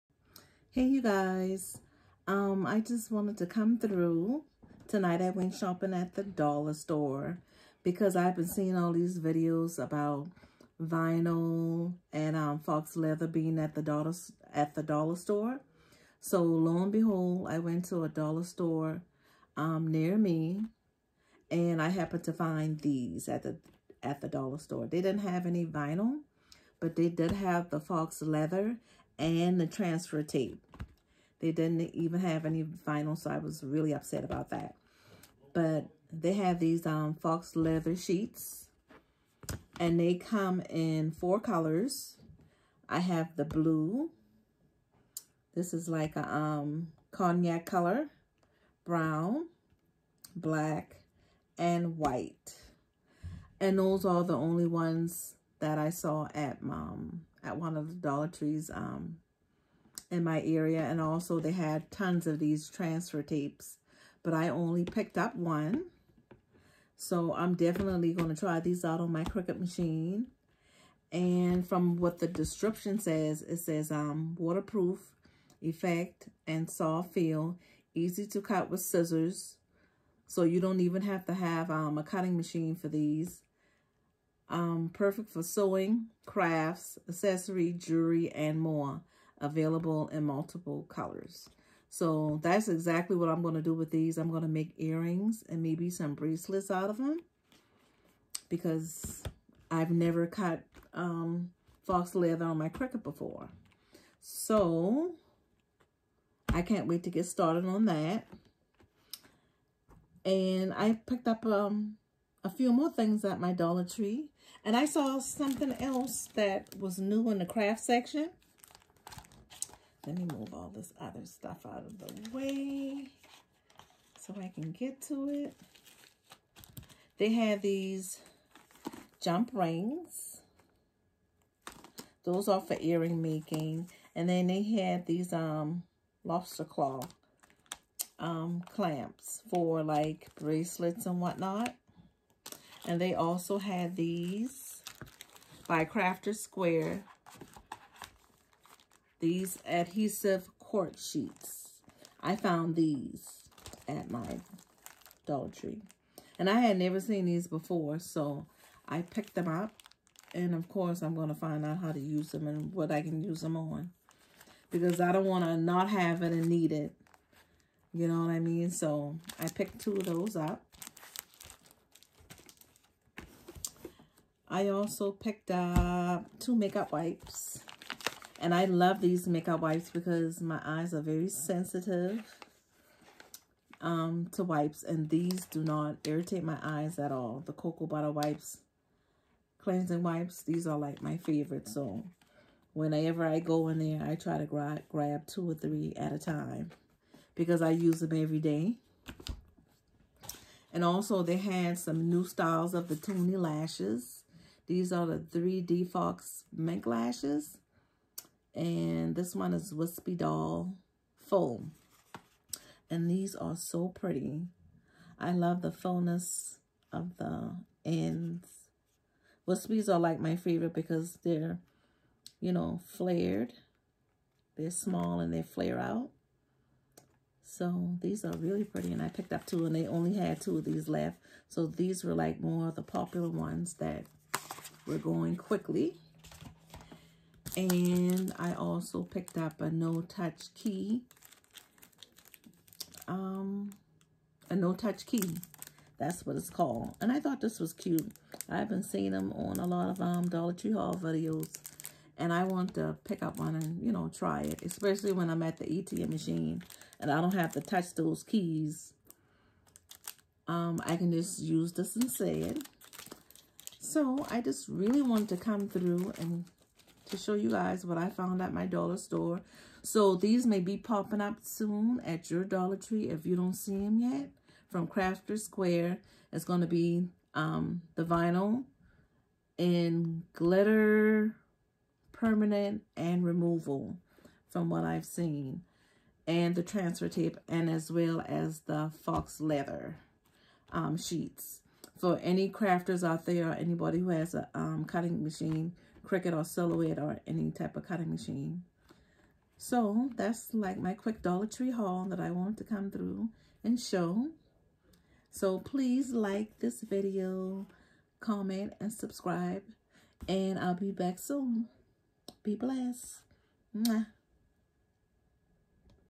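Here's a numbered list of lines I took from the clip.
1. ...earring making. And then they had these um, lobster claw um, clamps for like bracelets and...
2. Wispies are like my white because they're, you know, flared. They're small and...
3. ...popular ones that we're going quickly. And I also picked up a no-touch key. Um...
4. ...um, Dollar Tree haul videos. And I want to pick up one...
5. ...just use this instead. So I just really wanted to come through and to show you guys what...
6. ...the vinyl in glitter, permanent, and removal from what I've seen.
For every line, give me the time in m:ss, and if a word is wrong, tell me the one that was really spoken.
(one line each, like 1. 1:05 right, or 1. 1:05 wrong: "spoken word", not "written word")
1. 2:12 right
2. 3:39 wrong: "favorite", not "white"
3. 3:52 right
4. 4:10 right
5. 4:21 right
6. 4:37 right.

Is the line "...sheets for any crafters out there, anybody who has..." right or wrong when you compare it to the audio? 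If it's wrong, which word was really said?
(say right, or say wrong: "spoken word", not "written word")
right.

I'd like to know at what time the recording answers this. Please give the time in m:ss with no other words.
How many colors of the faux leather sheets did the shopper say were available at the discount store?
0:41.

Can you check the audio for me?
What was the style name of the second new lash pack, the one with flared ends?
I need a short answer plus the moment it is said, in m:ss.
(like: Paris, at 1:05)
Wispy Doll Foam, at 3:29.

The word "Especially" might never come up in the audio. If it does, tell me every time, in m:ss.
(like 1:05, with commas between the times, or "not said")
4:14.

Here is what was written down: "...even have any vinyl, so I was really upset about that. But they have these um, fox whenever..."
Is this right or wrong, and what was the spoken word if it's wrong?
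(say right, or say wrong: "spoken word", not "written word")
wrong: "leather", not "whenever".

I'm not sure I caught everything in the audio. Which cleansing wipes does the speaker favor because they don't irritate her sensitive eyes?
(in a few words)
Cocoa butter.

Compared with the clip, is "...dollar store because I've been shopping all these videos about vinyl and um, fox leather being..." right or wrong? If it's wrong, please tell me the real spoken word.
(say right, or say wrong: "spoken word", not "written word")
wrong: "seeing", not "shopping".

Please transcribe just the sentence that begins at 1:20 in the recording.
So you don't even have to have um, a cutting machine for these.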